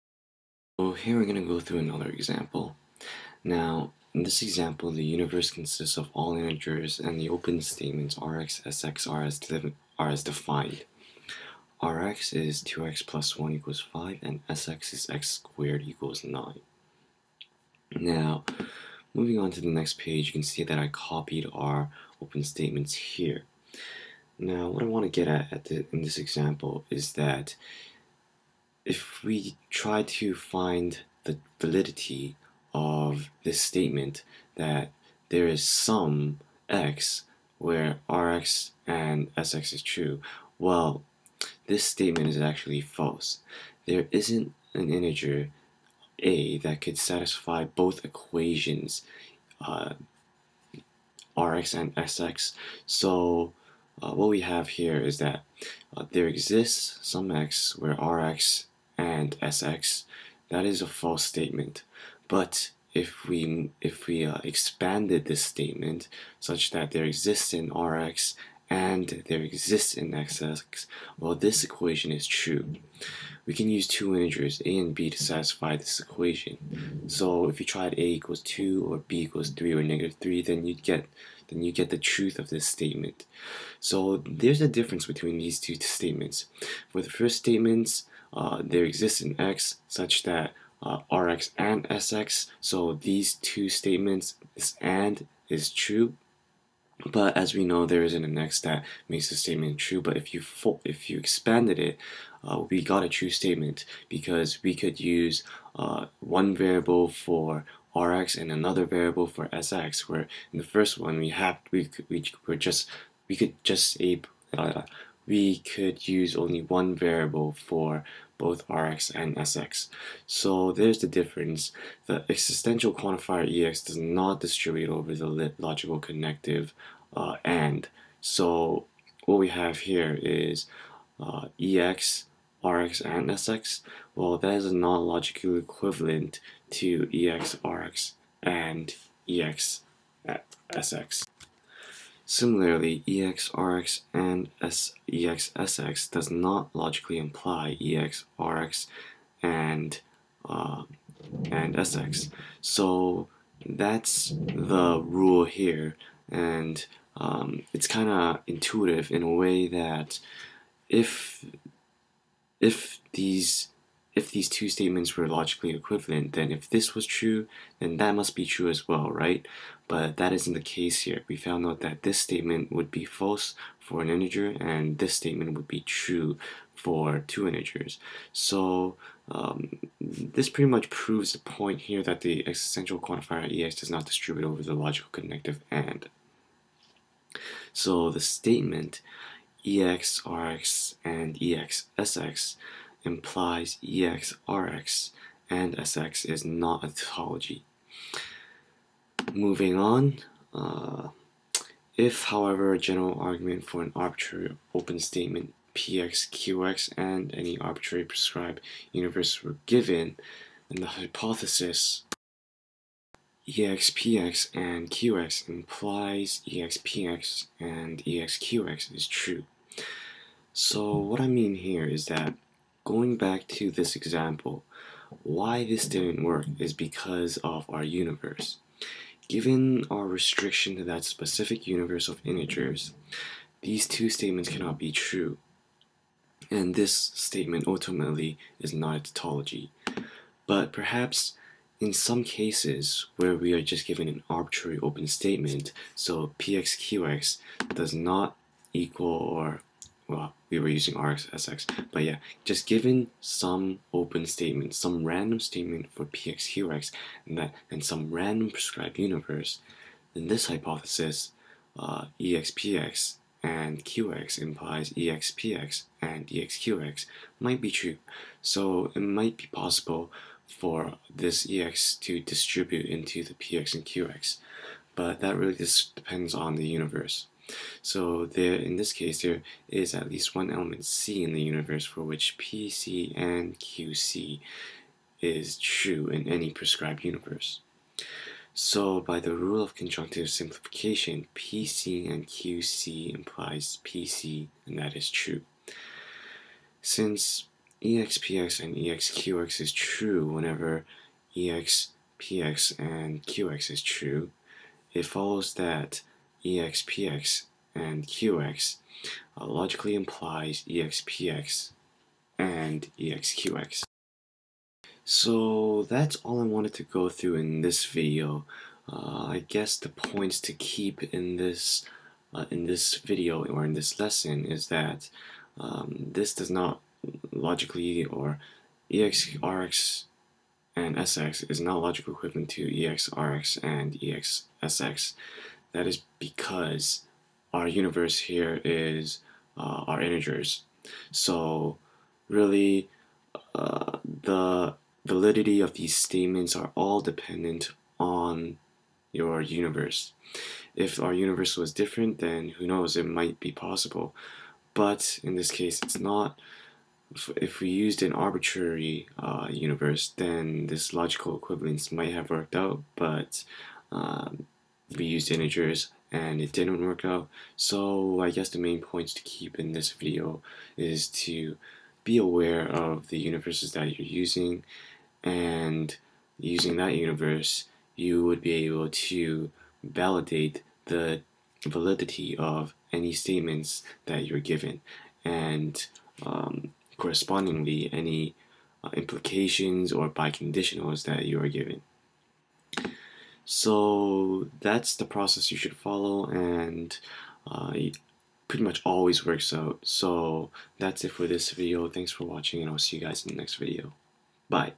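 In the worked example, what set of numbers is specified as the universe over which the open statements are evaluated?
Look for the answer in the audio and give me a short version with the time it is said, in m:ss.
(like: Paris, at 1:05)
all integers, at 0:06.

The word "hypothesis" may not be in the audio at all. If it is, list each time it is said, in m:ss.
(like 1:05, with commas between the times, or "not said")
3:30, 4:20.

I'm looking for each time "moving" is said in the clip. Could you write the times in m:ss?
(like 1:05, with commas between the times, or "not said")
0:19, 3:19.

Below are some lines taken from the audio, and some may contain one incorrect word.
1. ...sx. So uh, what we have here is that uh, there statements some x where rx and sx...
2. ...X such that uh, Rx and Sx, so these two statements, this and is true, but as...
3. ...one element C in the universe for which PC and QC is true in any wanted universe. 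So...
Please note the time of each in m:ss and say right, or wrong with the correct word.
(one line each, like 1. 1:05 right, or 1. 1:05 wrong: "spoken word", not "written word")
1. 0:51 wrong: "exists", not "statements"
2. 1:29 right
3. 4:40 wrong: "prescribed", not "wanted".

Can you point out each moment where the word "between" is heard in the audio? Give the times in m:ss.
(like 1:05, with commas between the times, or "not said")
1:25.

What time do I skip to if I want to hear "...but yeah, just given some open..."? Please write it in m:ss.
4:11.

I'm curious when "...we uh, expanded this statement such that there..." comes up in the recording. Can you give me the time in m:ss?
1:04.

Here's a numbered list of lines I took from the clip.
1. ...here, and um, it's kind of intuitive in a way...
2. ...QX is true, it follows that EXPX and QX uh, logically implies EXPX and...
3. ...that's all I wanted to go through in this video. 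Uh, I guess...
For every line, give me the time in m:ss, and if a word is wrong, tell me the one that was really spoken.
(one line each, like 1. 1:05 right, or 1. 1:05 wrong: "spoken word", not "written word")
1. 2:35 right
2. 5:03 right
3. 5:15 right.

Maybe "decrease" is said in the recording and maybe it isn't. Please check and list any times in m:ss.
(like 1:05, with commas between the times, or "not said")
not said.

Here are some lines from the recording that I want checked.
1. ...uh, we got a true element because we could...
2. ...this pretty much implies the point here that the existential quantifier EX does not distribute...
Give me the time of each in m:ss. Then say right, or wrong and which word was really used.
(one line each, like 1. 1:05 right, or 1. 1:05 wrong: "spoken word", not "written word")
1. 1:42 wrong: "statement", not "element"
2. 3:00 wrong: "proves", not "implies".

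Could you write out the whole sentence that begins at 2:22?
Similarly, EXRX and EXSX does not logically imply EXRX and uh, and SX.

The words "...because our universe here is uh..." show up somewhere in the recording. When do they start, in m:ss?
5:36.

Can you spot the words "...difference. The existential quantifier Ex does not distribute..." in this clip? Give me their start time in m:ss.
2:01.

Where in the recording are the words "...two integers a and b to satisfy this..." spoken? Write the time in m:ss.
1:13.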